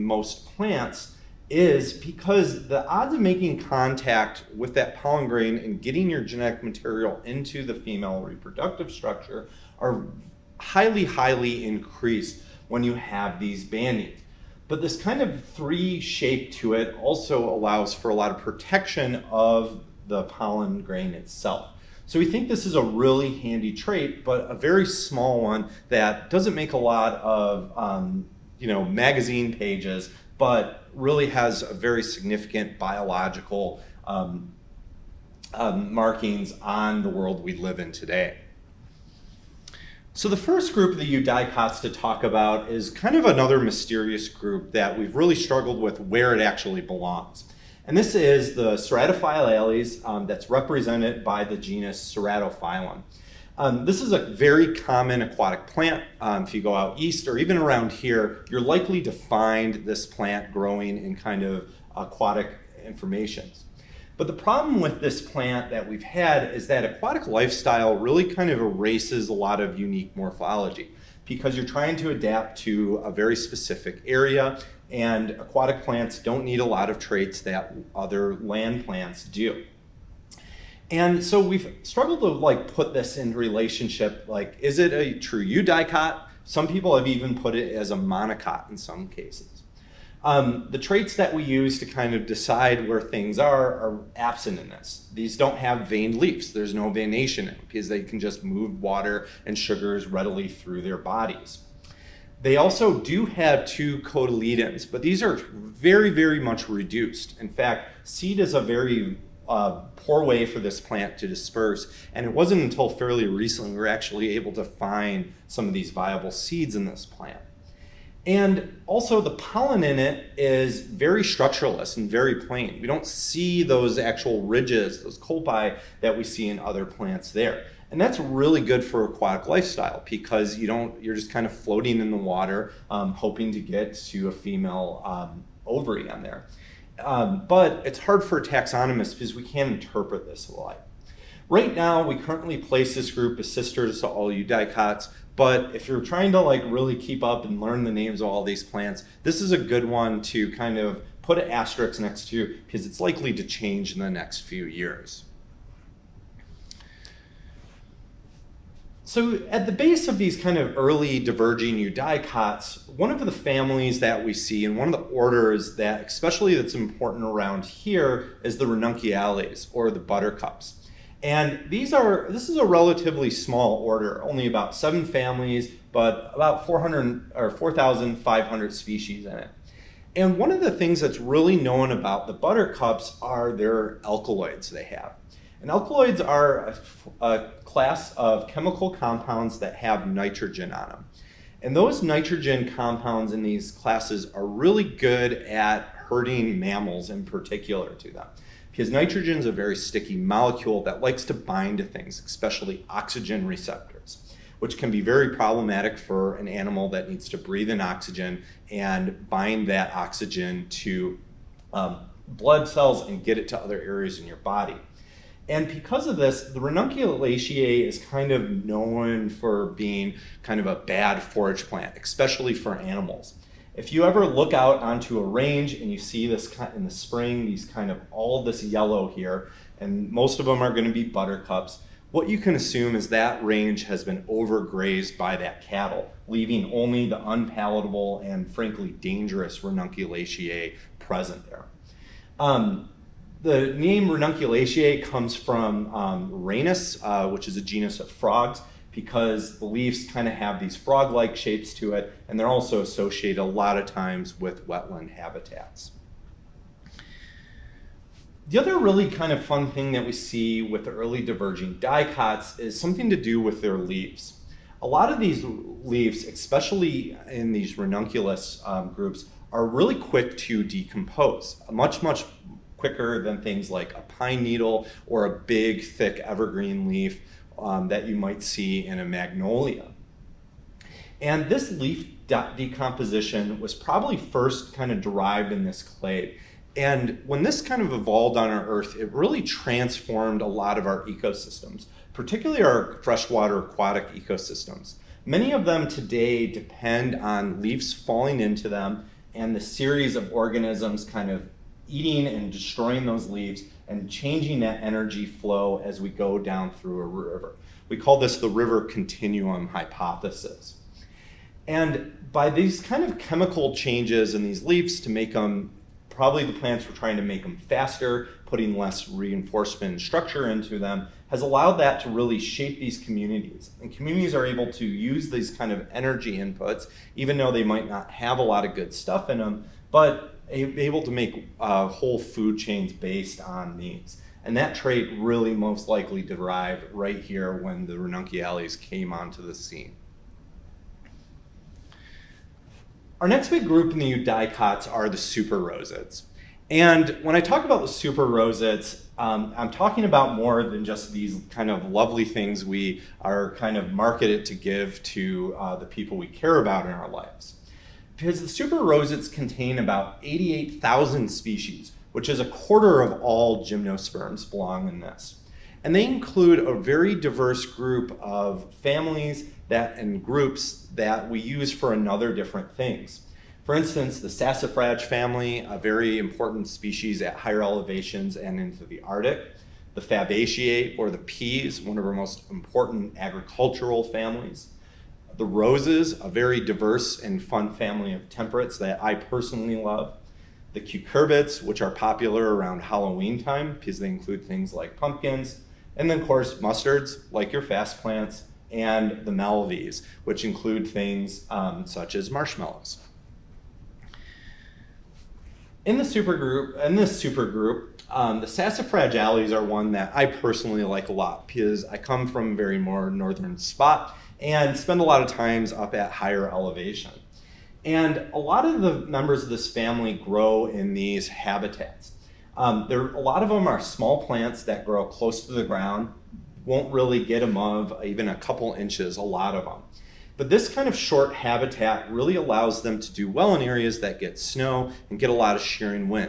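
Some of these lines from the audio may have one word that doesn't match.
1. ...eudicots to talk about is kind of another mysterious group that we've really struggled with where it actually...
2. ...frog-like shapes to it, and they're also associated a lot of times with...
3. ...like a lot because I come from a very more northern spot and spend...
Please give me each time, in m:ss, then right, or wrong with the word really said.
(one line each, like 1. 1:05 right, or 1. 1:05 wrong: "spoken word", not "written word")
1. 0:41 right
2. 4:10 right
3. 6:50 right.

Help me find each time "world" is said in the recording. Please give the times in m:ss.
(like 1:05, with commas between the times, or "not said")
0:37.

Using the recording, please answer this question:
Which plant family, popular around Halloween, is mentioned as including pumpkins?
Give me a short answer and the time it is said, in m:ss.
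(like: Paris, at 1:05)
cucurbits, at 6:30.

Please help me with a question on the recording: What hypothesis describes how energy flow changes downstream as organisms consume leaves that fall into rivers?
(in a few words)
river continuum hypothesis.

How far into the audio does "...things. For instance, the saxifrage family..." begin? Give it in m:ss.
6:12.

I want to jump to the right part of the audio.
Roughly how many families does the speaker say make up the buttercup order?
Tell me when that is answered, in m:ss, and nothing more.
2:54.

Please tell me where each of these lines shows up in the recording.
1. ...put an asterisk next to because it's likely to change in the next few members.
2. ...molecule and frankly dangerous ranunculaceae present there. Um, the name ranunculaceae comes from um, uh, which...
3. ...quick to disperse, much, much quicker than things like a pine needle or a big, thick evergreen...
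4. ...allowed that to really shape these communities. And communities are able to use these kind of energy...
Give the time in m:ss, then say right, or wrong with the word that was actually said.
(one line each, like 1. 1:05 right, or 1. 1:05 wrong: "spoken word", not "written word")
1. 2:31 wrong: "years", not "members"
2. 3:57 wrong: "unpalatable", not "molecule"
3. 4:29 wrong: "decompose", not "disperse"
4. 5:21 right.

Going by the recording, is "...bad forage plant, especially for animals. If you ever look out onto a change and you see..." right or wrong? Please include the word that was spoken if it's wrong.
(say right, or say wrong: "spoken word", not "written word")
wrong: "range", not "change".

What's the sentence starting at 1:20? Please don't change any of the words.
And so we've struggled to like put this in relationship, like is it a true eudicot?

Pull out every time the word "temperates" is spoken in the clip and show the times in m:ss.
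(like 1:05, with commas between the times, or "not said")
6:28.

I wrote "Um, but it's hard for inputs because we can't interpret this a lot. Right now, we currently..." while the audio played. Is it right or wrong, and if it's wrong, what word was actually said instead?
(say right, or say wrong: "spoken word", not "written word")
wrong: "taxonomists", not "inputs".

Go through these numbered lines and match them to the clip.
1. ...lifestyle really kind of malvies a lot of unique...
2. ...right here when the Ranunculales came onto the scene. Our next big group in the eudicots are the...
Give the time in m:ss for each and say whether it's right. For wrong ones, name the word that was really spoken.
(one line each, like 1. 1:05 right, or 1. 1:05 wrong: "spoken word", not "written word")
1. 1:07 wrong: "erases", not "malvies"
2. 5:36 right.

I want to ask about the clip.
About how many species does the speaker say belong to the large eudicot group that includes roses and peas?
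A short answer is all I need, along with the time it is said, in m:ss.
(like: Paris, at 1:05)
88,000, at 6:00.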